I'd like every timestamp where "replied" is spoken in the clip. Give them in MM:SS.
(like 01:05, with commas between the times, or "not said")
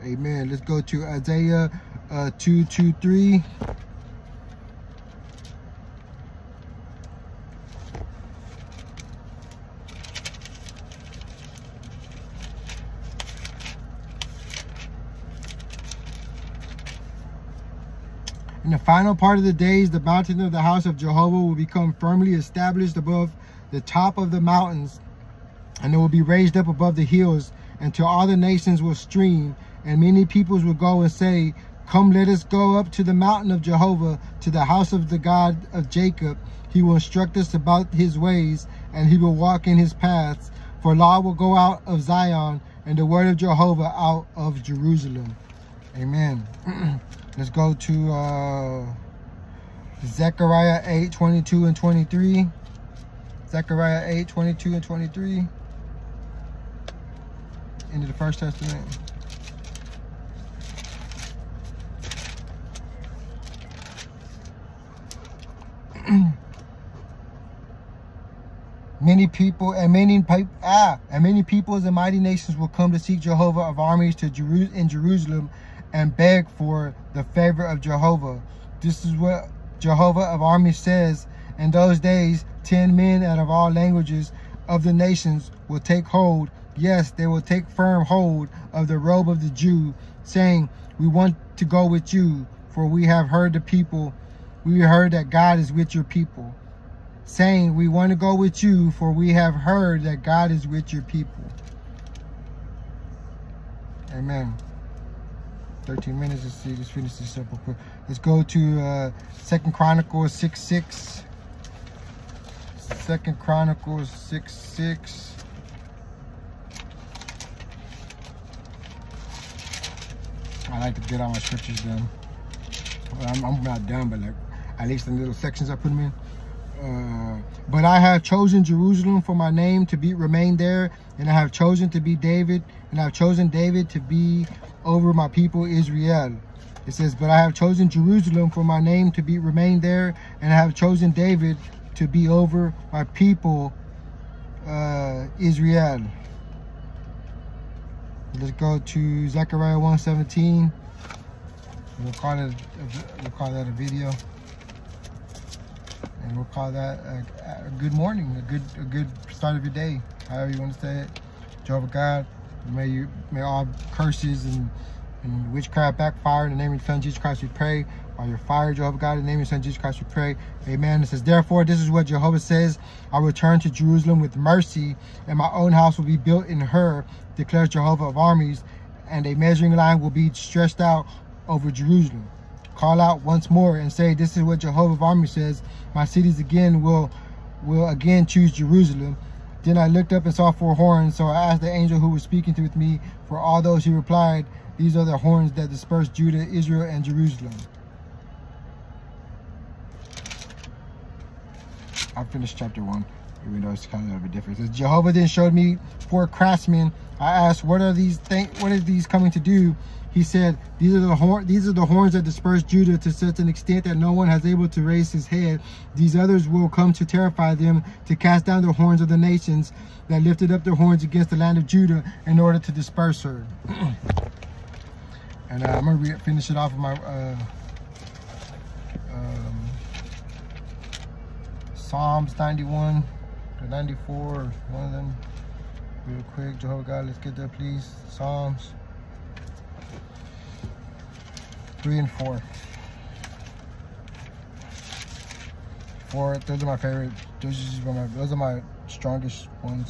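03:13.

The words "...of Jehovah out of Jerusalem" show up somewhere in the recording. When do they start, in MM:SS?
00:43.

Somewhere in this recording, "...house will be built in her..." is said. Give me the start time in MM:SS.
02:55.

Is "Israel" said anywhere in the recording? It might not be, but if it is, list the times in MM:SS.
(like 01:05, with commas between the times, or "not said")
02:15, 02:25, 03:16.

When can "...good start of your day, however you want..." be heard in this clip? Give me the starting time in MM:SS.
02:38.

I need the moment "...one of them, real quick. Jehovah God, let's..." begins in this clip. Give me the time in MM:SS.
03:54.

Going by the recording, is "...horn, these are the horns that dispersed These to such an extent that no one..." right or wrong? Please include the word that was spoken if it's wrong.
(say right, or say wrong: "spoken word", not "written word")
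wrong: "Judah", not "These".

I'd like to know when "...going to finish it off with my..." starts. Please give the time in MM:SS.
03:45.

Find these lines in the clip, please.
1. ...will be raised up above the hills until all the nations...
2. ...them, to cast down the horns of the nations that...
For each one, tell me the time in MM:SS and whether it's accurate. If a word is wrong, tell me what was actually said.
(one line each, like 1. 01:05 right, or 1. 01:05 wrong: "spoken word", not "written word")
1. 00:25 right
2. 03:37 right.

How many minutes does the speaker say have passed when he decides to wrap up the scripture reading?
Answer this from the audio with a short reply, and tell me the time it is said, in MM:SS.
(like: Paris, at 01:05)
13, at 01:45.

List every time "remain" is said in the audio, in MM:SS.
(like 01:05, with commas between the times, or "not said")
02:10, 02:19.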